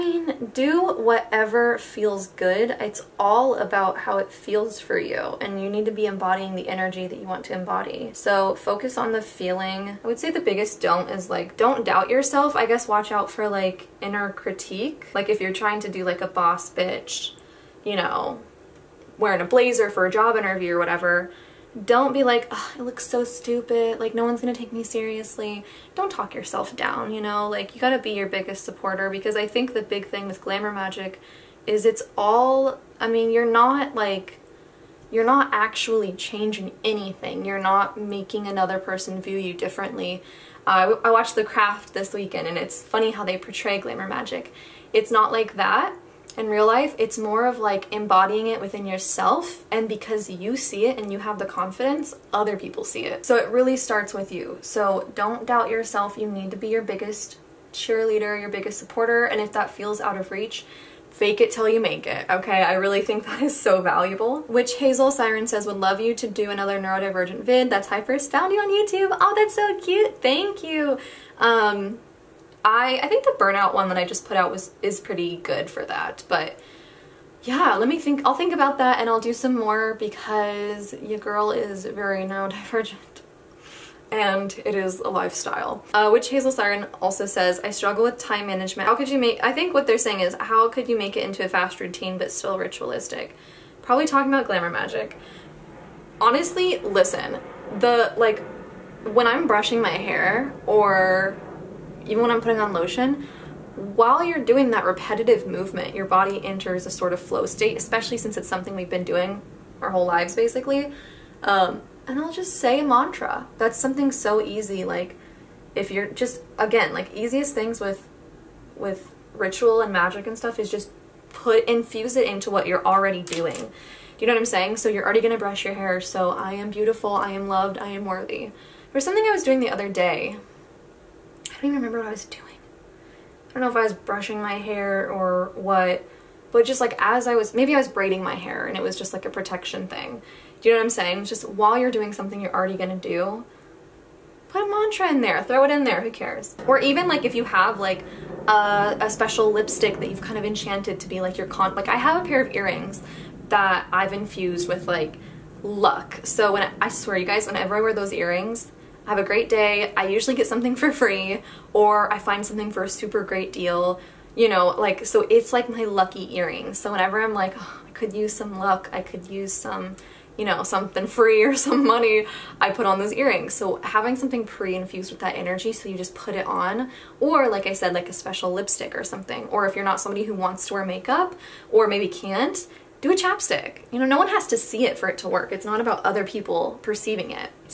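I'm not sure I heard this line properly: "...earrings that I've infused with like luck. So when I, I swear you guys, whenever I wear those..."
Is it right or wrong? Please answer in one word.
right.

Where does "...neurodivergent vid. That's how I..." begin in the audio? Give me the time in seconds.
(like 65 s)
66 s.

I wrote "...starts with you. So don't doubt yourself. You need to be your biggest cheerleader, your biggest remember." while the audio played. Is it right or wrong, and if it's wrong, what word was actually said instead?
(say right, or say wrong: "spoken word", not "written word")
wrong: "supporter", not "remember".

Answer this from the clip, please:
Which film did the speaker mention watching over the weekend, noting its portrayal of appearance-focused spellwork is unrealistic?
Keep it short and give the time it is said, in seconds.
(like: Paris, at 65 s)
The Craft, at 41 s.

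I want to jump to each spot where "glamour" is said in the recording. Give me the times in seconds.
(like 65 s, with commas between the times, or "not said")
30 s, 43 s, 94 s.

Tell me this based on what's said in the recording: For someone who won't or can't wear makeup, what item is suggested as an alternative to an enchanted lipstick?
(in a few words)
chapstick.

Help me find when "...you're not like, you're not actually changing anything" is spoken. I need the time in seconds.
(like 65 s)
33 s.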